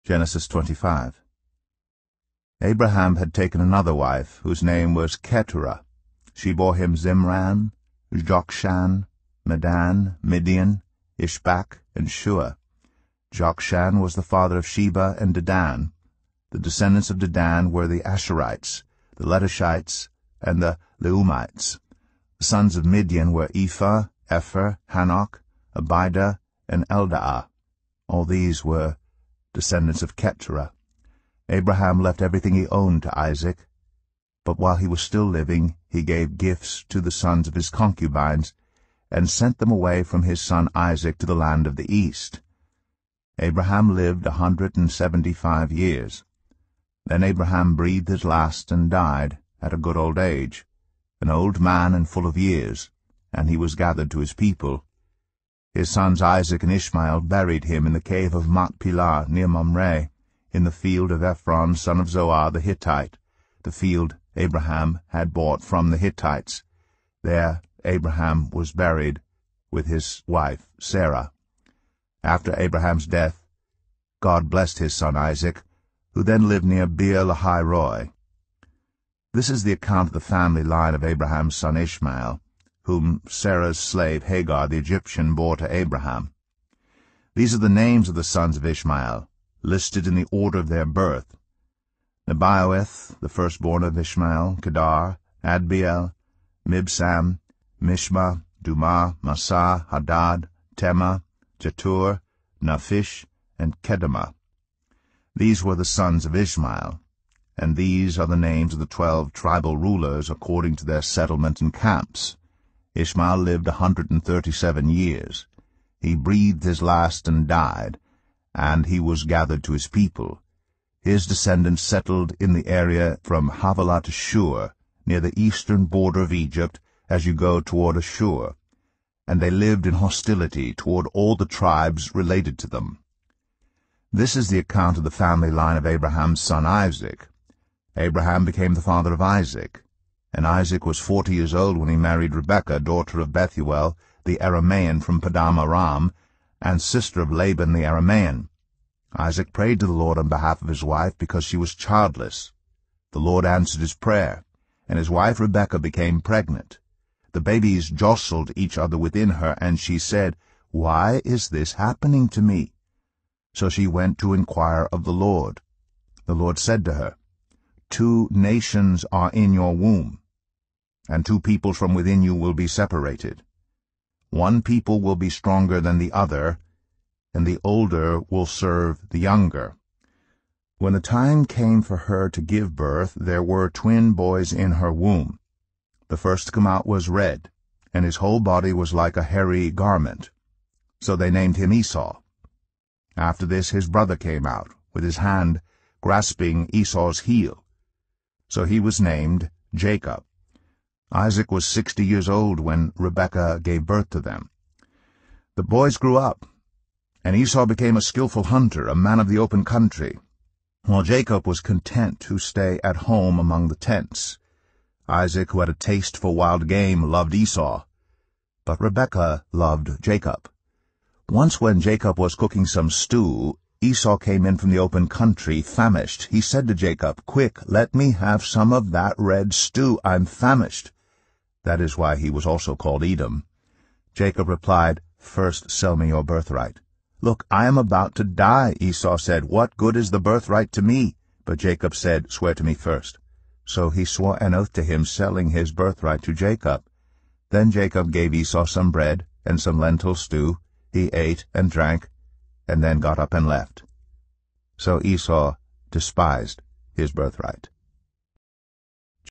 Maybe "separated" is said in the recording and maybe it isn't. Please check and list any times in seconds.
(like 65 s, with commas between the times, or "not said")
172 s.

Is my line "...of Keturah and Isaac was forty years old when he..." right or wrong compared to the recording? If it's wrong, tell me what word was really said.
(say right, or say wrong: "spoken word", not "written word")
wrong: "Isaac", not "Keturah".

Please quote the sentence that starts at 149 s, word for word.
Isaac prayed to the Lord on behalf of his wife because she was childless.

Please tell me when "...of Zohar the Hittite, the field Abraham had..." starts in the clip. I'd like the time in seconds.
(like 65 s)
62 s.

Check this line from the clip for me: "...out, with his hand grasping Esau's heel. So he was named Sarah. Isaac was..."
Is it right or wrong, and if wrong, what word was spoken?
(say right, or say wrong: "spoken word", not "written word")
wrong: "Jacob", not "Sarah".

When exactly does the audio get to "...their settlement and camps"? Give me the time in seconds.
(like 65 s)
110 s.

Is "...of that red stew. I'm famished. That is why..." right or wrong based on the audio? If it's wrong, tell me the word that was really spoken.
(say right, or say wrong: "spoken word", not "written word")
right.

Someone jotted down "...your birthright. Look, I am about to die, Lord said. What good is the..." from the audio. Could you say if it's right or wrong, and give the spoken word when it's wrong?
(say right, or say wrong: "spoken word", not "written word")
wrong: "Esau", not "Lord".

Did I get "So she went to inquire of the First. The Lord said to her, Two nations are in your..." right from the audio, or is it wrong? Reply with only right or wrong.
wrong.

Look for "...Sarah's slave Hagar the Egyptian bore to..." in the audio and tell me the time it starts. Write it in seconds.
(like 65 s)
83 s.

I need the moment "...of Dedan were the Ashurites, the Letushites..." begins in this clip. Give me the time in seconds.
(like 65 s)
17 s.